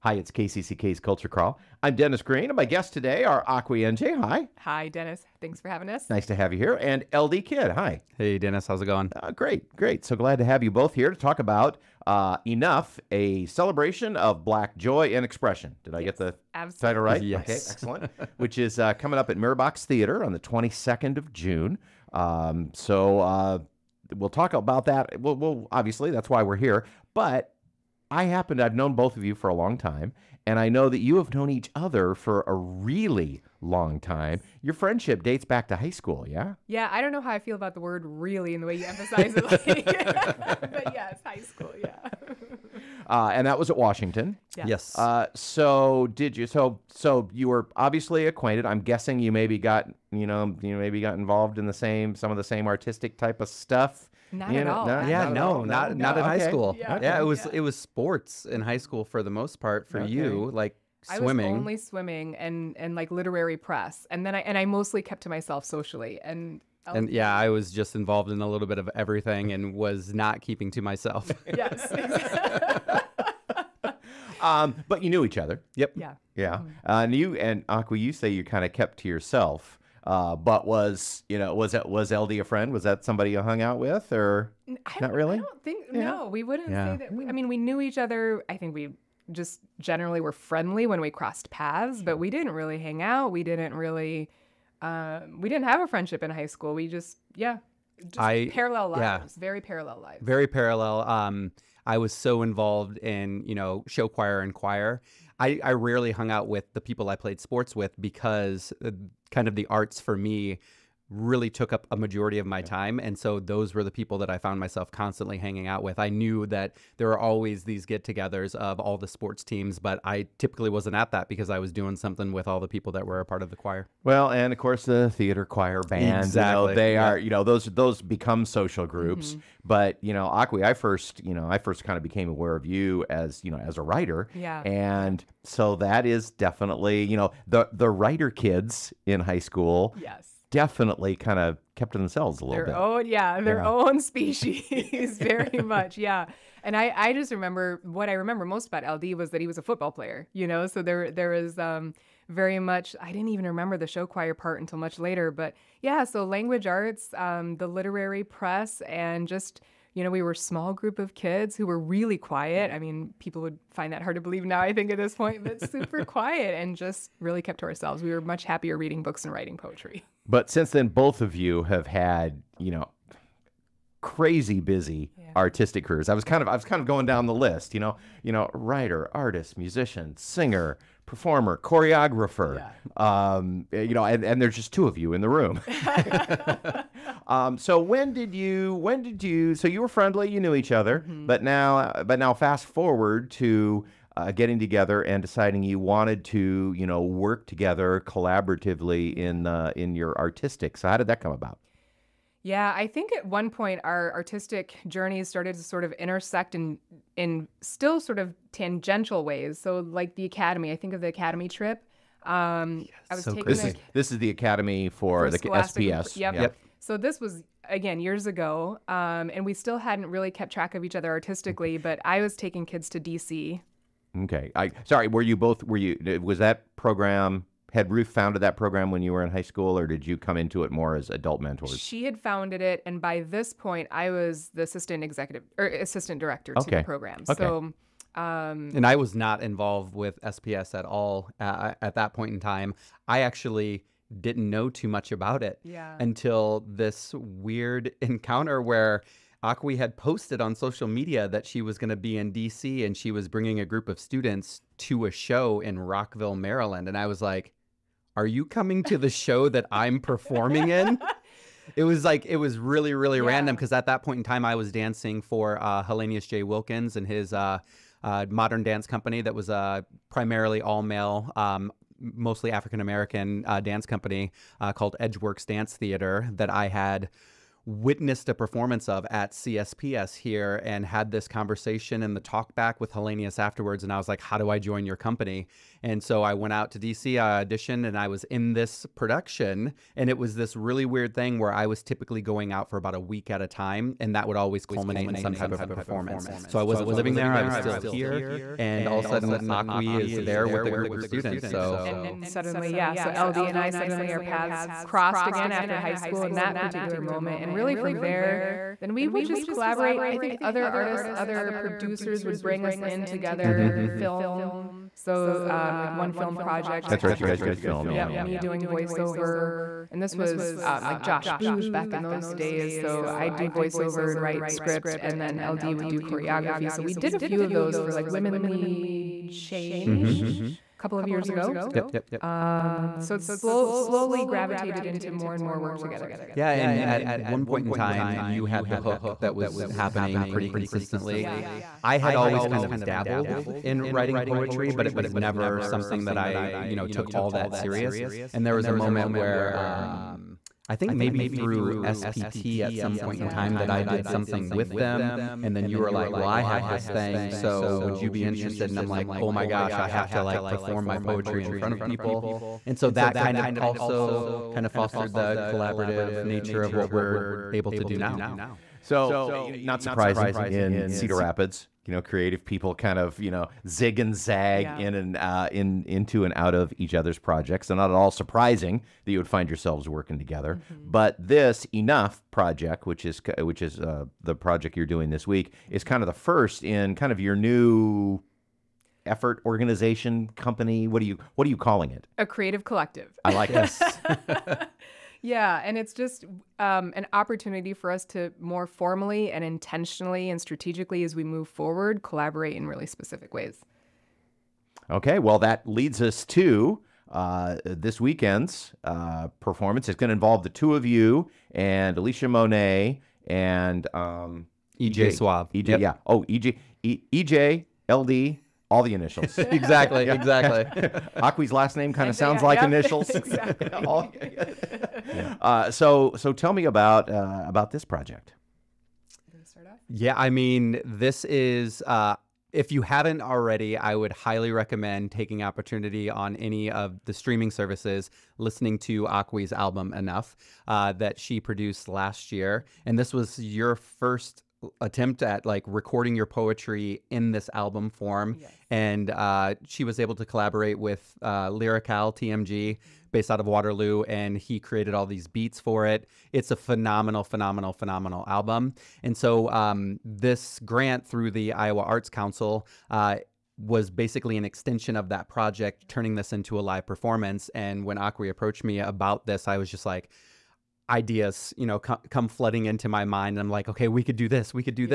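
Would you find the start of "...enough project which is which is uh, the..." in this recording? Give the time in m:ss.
6:21.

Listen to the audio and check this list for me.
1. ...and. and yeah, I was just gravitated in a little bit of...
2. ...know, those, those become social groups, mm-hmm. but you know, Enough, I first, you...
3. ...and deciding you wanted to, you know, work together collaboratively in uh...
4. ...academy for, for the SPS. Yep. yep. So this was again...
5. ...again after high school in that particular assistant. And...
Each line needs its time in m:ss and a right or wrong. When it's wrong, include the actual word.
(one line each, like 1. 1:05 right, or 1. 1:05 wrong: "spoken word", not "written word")
1. 1:06 wrong: "involved", not "gravitated"
2. 2:07 wrong: "Akwi", not "Enough"
3. 3:15 right
4. 3:34 right
5. 5:05 wrong: "moment", not "assistant".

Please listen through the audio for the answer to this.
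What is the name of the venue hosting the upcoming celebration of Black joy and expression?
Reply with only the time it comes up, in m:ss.
0:19.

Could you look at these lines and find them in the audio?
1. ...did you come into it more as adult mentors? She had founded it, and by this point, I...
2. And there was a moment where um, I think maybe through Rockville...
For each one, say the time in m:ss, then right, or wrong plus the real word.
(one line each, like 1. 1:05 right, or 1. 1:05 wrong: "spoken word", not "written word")
1. 3:49 right
2. 5:48 wrong: "SPT", not "Rockville".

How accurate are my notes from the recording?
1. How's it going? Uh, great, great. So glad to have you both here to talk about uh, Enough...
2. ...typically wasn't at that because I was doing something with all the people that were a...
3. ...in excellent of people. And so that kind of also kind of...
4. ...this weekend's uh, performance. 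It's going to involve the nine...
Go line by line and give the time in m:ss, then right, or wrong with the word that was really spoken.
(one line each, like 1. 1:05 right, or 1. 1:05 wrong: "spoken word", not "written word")
1. 0:08 right
2. 2:00 right
3. 6:01 wrong: "front", not "excellent"
4. 6:47 wrong: "two", not "nine".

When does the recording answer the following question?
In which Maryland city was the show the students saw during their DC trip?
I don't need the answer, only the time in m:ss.
4:15.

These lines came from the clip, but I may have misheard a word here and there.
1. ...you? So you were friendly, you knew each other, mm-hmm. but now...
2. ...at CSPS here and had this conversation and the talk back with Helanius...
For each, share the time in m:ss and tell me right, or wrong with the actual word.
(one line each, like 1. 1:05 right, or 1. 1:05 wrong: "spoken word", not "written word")
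1. 3:09 right
2. 4:39 right.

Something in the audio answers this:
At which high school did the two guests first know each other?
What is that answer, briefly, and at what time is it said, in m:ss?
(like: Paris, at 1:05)
Washington, at 0:43.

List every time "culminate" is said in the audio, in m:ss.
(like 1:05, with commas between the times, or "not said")
4:54.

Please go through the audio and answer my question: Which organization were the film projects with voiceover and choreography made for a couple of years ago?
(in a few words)
Women Lead Change.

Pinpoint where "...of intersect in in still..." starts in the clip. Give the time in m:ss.
3:25.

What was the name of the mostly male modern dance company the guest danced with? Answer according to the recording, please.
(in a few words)
Edgeworks Dance Theater.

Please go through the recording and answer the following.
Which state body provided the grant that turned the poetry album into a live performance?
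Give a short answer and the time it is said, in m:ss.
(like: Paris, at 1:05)
Iowa Arts Council, at 7:41.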